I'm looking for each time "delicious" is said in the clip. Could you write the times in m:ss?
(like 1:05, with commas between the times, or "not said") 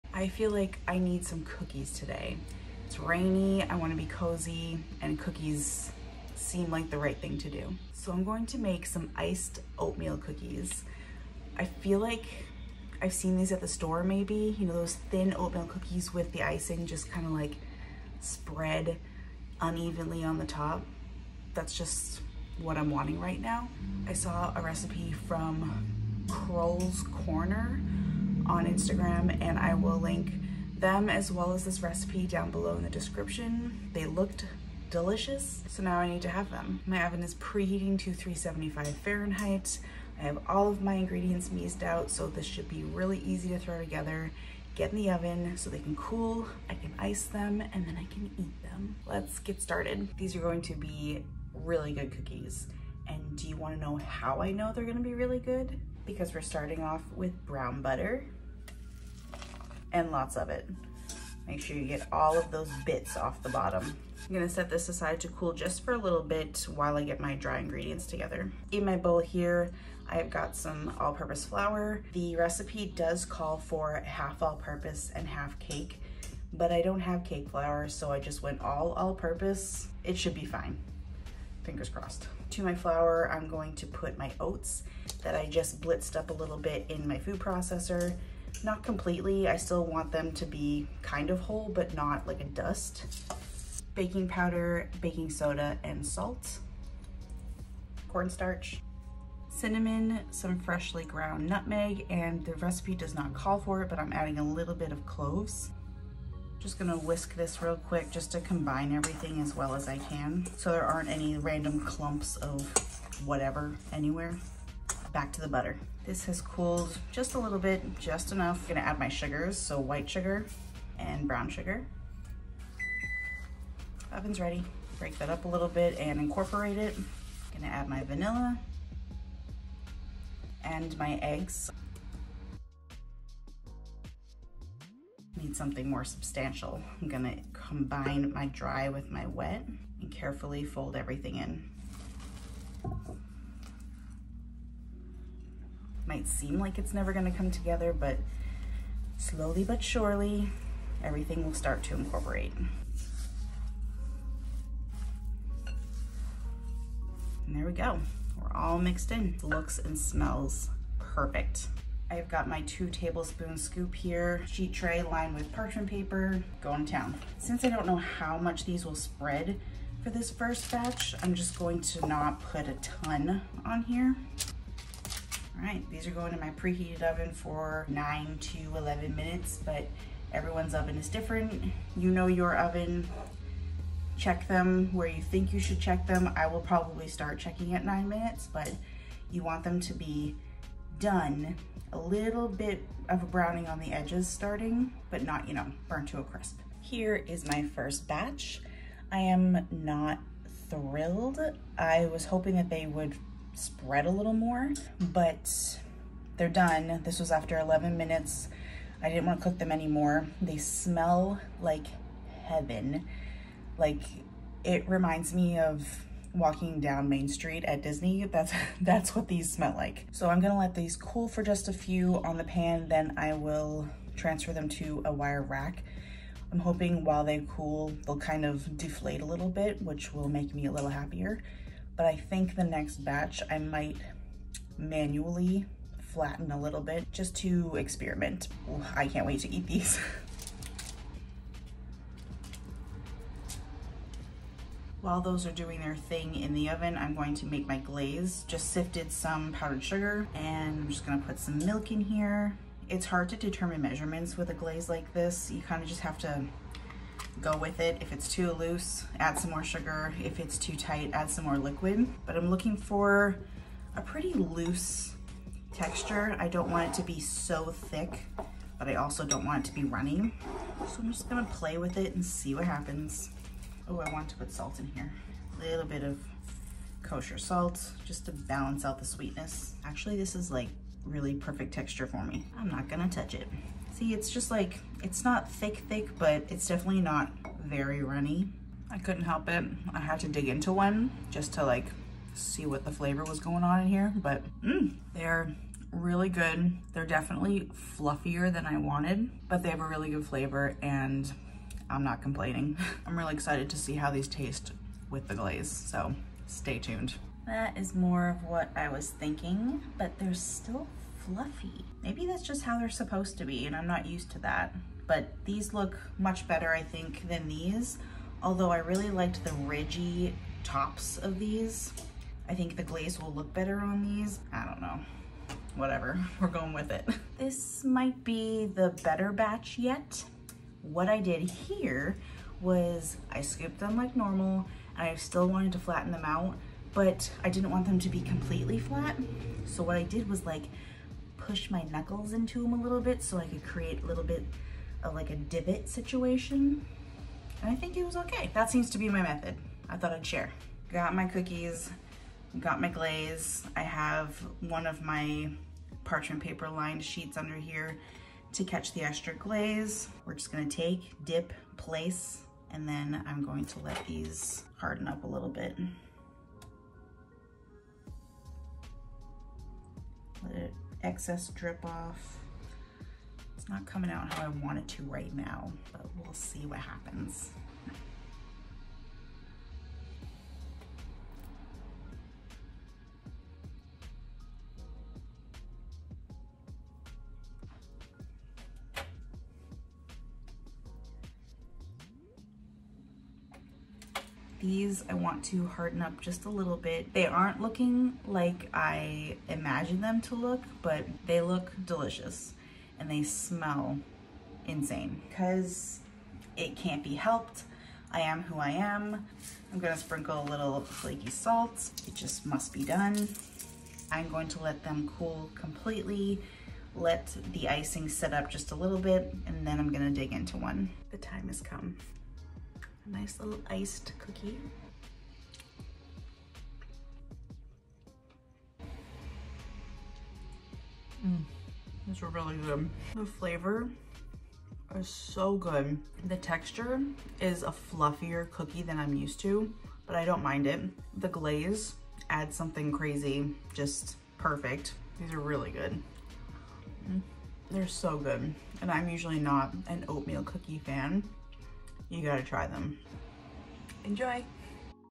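0:34, 6:41.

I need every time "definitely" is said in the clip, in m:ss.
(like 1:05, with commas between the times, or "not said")
4:46, 4:57.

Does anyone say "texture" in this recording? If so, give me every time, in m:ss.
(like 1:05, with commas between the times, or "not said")
4:25, 4:41, 7:16.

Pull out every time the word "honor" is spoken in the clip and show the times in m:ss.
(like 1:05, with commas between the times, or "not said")
not said.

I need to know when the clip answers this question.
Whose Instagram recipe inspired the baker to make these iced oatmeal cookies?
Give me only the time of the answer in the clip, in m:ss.
0:26.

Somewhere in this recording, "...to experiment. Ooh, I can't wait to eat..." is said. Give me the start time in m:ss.
3:57.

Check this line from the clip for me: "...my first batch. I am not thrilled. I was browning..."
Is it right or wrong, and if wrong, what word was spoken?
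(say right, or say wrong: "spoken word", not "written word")
wrong: "hoping", not "browning".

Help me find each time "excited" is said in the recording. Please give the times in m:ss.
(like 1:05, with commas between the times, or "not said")
5:03.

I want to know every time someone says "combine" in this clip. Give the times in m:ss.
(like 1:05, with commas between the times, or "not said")
1:48, 2:17.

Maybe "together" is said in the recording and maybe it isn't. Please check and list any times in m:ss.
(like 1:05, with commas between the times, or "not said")
0:43, 1:08, 2:27.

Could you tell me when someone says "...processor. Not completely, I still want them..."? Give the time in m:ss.
1:27.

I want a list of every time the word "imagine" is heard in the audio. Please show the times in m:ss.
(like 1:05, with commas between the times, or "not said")
6:39.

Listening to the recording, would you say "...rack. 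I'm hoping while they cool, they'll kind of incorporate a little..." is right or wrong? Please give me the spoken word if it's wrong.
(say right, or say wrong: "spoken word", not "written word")
wrong: "deflate", not "incorporate".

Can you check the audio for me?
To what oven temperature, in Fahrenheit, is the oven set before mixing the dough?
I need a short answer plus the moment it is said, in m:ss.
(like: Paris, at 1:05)
375, at 0:38.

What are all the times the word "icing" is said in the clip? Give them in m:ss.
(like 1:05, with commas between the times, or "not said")
0:16, 6:57.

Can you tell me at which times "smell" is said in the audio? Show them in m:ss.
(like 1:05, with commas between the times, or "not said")
2:39, 3:30, 3:39, 6:43.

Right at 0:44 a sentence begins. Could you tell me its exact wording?
Get in the oven so they can cool, I can ice them, and then I can eat them.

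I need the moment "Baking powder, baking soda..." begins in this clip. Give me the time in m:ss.
1:33.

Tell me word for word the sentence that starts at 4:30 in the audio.
So I'm just gonna play with it and see what happens.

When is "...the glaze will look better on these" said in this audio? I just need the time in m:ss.
5:22.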